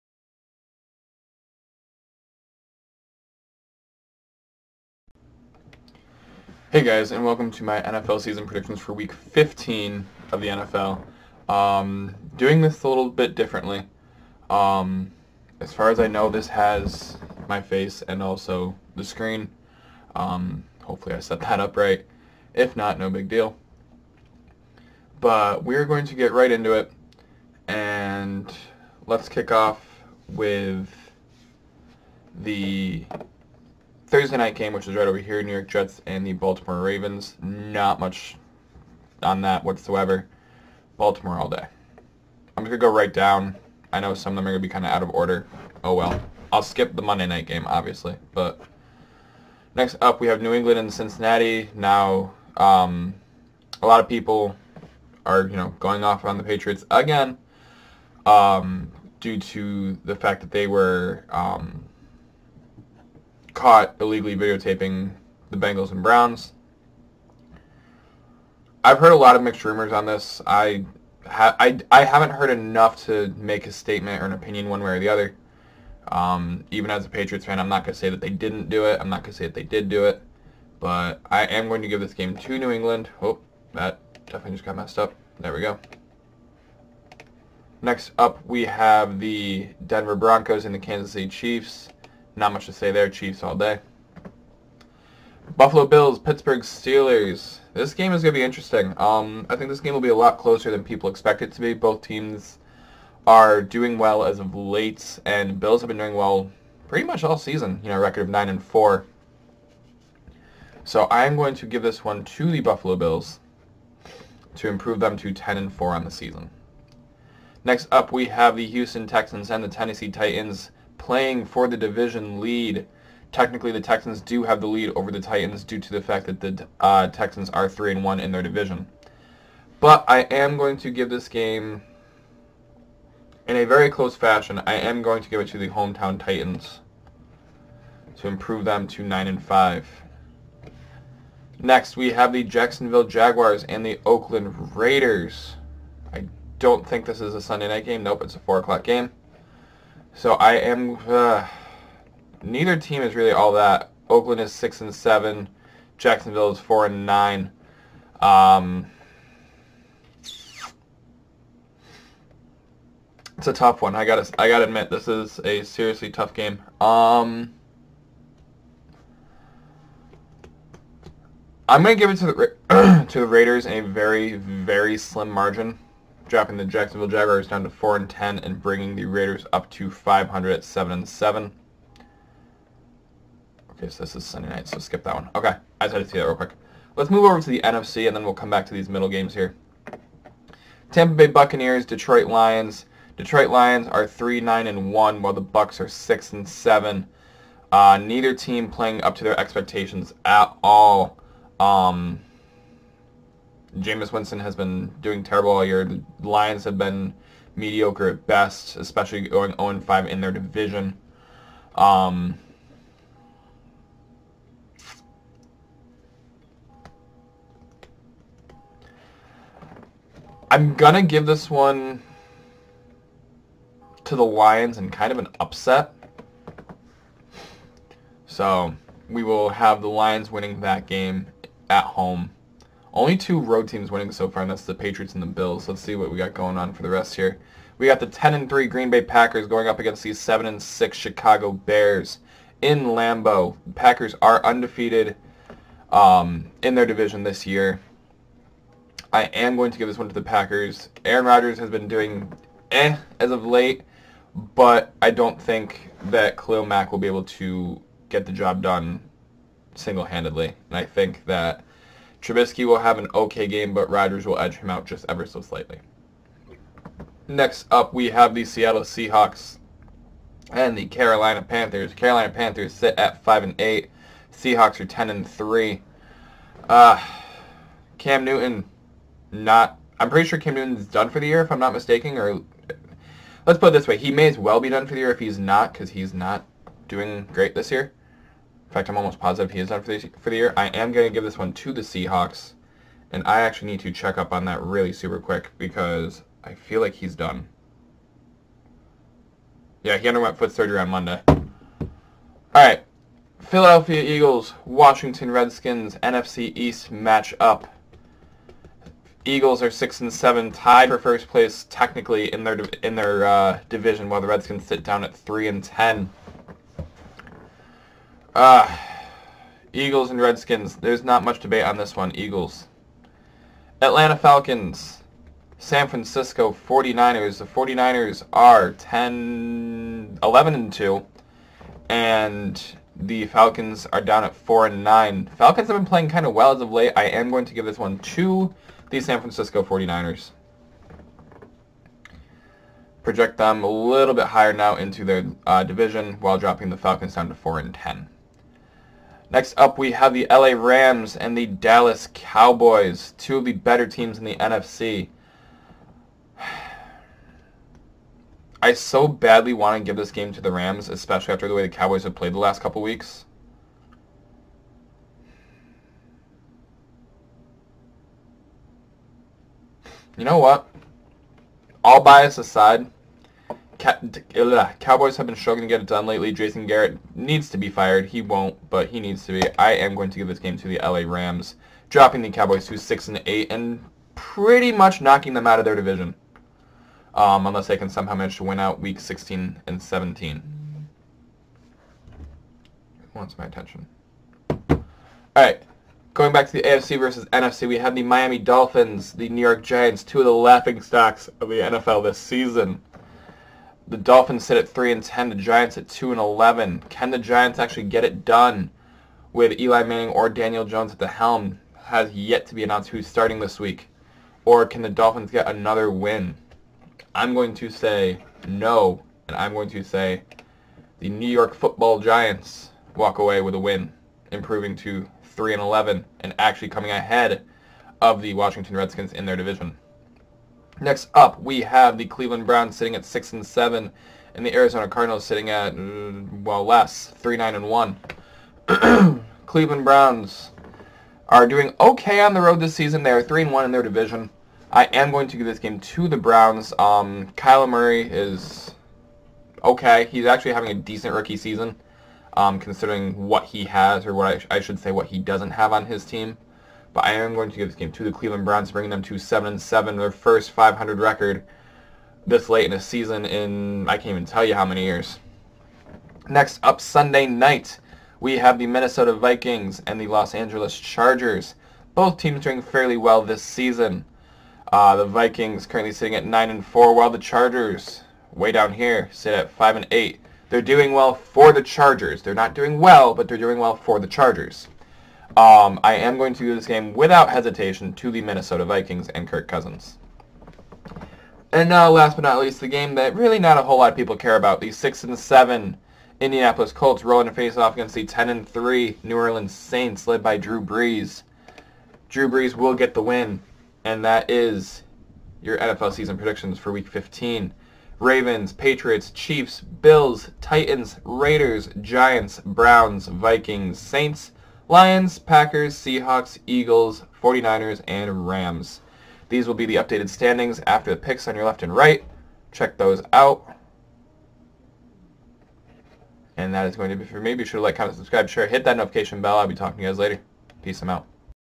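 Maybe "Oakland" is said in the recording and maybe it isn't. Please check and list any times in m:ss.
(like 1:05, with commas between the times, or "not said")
2:24, 2:34.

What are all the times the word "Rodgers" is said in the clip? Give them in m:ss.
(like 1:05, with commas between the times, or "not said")
4:11, 4:23.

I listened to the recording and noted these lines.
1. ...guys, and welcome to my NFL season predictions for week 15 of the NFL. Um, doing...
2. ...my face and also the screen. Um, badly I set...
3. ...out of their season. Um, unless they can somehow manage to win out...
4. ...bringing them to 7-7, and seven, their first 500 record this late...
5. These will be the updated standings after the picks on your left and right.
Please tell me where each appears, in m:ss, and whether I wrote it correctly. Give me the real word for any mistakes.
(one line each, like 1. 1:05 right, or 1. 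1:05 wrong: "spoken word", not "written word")
1. 0:06 right
2. 0:17 wrong: "hopefully", not "badly"
3. 6:25 wrong: "division", not "season"
4. 7:38 right
5. 8:39 right.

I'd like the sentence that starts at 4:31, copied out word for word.
Carolina Panthers sit at 5 and 8.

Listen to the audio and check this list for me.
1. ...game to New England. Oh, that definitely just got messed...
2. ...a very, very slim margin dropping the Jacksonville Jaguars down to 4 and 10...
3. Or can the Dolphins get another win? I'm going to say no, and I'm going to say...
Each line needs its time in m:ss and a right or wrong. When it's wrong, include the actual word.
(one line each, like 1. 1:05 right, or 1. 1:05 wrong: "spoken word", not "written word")
1. 1:22 right
2. 2:53 right
3. 6:54 right.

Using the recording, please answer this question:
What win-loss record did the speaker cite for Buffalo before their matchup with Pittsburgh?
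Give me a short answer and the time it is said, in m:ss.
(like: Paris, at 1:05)
9-4, at 1:48.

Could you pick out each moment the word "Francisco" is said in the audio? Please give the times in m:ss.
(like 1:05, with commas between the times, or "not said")
5:25, 5:39.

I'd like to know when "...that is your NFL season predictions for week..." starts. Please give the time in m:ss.
8:24.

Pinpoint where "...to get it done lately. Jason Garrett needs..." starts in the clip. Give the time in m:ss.
6:15.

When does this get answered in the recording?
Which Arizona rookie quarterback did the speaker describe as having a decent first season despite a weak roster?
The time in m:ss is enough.
7:27.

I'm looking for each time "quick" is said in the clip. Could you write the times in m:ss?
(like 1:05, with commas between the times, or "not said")
3:06, 4:55.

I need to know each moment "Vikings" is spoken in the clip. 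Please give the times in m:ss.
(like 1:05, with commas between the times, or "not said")
7:49, 7:55, 8:08, 8:33.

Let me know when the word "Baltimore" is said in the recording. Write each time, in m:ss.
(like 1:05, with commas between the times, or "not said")
0:36, 0:40.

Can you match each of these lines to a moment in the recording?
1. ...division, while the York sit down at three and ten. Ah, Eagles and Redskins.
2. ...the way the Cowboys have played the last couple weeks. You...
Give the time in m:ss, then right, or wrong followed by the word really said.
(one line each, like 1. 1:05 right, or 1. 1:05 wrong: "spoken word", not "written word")
1. 5:13 wrong: "Redskins", not "York"
2. 6:01 right.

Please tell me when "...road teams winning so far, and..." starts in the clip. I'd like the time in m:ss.
3:53.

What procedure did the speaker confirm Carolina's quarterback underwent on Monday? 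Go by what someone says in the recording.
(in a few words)
Foot surgery.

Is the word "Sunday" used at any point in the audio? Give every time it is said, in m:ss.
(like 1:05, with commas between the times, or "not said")
2:27, 3:04, 7:46.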